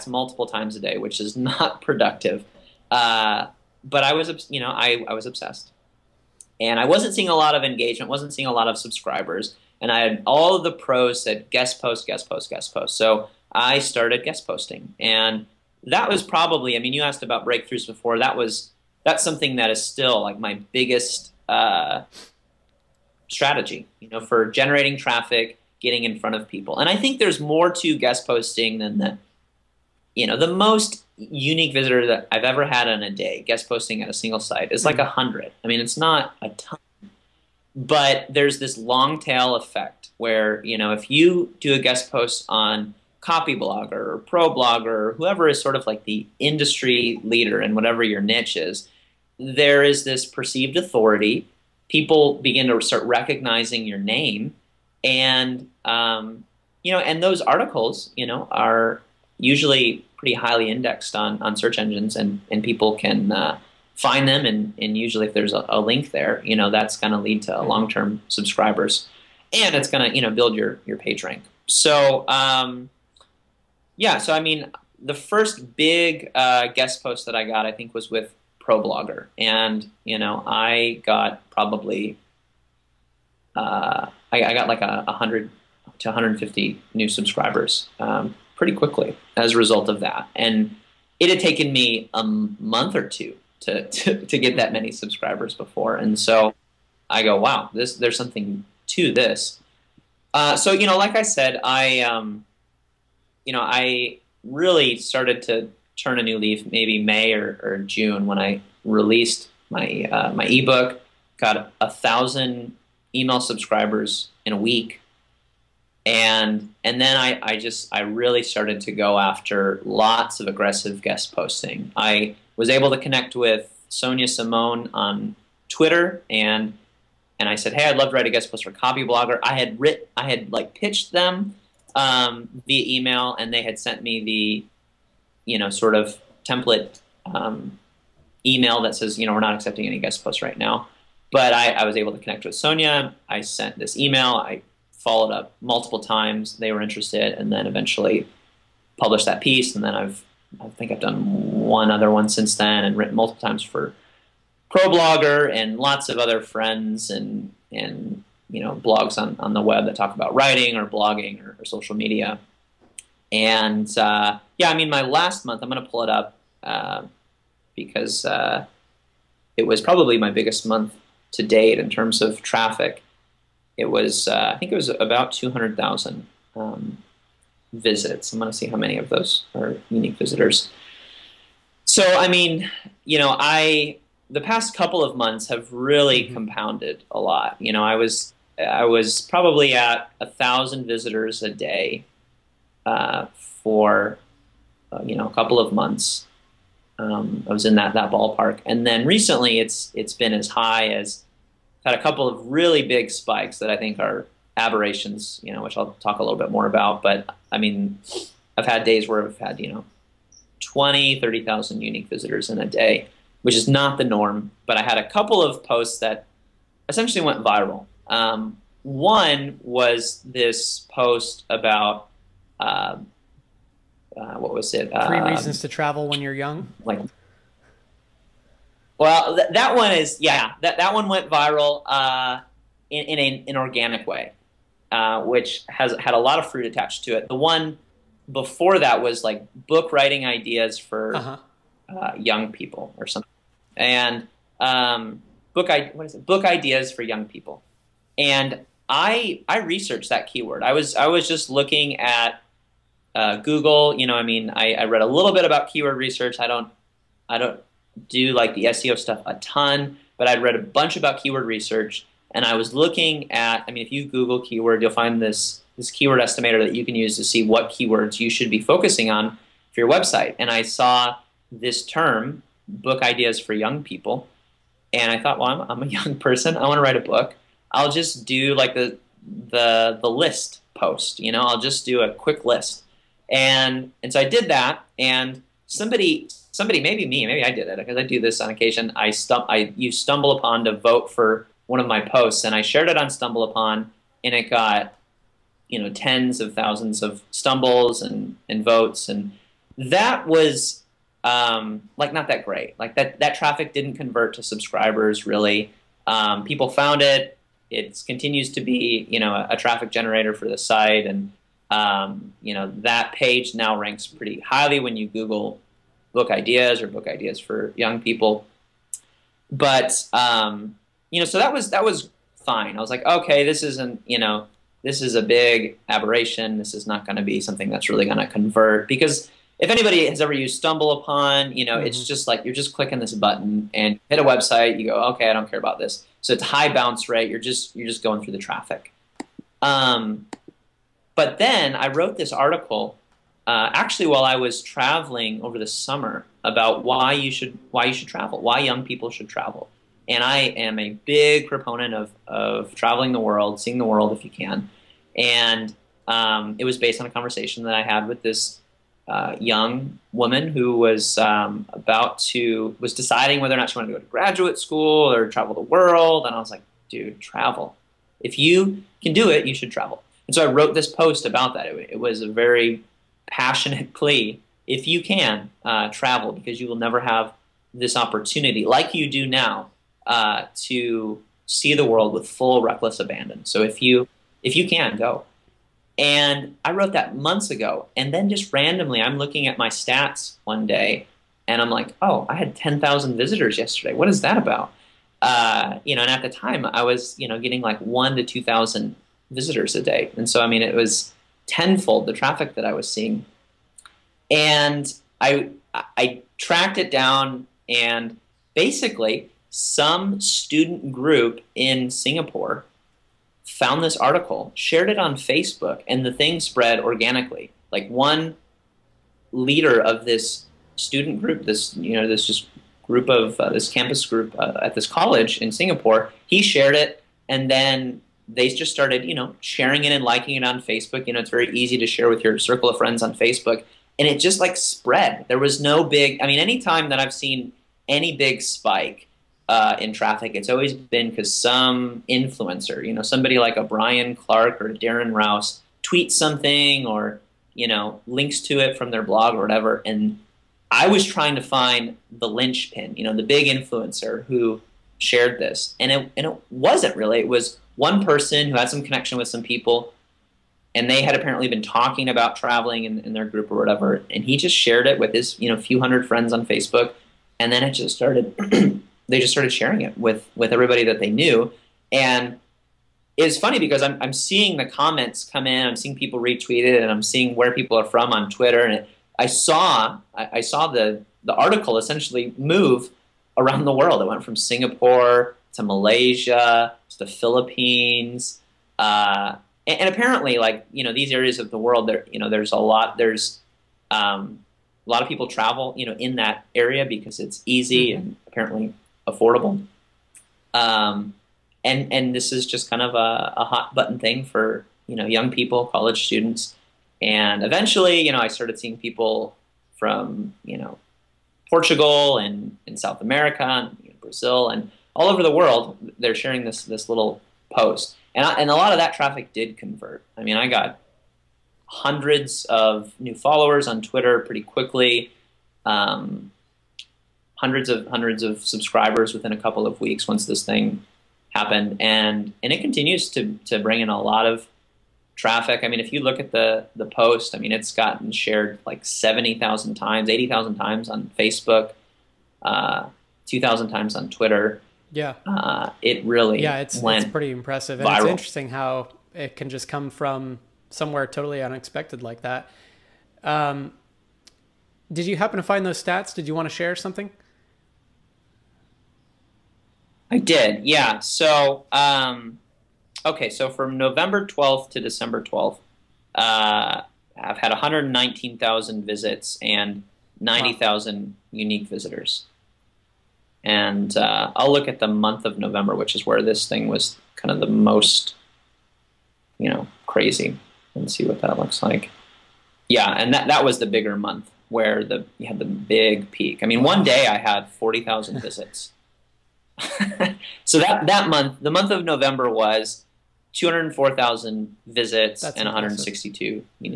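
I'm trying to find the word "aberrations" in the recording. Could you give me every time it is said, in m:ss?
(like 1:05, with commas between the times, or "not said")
3:24, 5:25.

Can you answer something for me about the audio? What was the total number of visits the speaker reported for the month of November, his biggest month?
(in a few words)
204000.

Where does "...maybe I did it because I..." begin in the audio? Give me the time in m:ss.
4:47.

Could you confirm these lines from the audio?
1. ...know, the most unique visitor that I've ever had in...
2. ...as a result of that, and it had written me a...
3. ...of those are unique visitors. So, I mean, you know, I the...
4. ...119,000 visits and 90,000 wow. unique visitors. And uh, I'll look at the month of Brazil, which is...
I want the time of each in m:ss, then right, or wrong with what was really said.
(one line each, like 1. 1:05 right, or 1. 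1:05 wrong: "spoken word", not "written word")
1. 0:30 right
2. 1:29 wrong: "taken", not "written"
3. 2:58 right
4. 9:27 wrong: "November", not "Brazil".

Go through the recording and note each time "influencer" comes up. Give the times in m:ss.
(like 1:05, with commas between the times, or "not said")
7:22, 7:33.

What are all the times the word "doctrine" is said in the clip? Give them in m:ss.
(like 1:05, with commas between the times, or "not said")
not said.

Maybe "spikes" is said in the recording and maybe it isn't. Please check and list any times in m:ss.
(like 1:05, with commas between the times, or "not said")
3:23, 7:18.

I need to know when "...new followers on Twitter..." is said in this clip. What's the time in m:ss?
8:42.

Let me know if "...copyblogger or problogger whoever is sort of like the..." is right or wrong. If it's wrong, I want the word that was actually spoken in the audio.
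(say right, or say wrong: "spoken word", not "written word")
right.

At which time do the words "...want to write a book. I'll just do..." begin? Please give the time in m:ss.
4:36.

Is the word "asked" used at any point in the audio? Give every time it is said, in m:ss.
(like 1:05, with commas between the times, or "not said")
0:17.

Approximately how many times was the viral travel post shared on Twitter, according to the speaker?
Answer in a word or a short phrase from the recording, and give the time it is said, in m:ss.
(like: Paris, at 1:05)
2000, at 9:03.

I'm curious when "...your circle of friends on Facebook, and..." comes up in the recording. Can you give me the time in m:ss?
7:12.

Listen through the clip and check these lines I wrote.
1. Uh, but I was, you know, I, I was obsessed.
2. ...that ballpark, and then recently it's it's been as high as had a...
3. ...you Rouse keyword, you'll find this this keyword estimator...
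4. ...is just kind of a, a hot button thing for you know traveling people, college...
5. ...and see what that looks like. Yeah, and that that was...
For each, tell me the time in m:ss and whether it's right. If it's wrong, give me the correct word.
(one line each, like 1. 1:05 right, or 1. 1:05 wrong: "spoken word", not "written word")
1. 0:02 right
2. 3:17 right
3. 4:23 wrong: "Google", not "Rouse"
4. 8:22 wrong: "young", not "traveling"
5. 9:40 right.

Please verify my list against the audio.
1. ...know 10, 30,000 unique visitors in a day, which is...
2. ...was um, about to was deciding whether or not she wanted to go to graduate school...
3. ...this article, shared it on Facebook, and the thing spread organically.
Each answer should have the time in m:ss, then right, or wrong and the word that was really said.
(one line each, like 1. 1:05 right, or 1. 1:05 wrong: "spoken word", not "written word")
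1. 3:29 wrong: "20", not "10"
2. 6:00 right
3. 6:53 right.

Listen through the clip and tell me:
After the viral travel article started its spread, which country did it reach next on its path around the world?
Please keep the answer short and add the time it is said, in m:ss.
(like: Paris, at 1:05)
Malaysia, at 8:05.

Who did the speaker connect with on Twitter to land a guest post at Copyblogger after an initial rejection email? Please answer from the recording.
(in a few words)
Sonia Simone.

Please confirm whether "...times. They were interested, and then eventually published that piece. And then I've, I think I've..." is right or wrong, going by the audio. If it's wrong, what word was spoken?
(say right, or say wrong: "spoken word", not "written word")
right.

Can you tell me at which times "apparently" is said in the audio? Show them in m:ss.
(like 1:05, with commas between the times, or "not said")
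7:41, 8:09, 8:18.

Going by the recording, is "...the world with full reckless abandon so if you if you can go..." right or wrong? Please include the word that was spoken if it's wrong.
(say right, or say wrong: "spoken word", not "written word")
right.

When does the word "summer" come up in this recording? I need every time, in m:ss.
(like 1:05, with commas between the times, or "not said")
5:45.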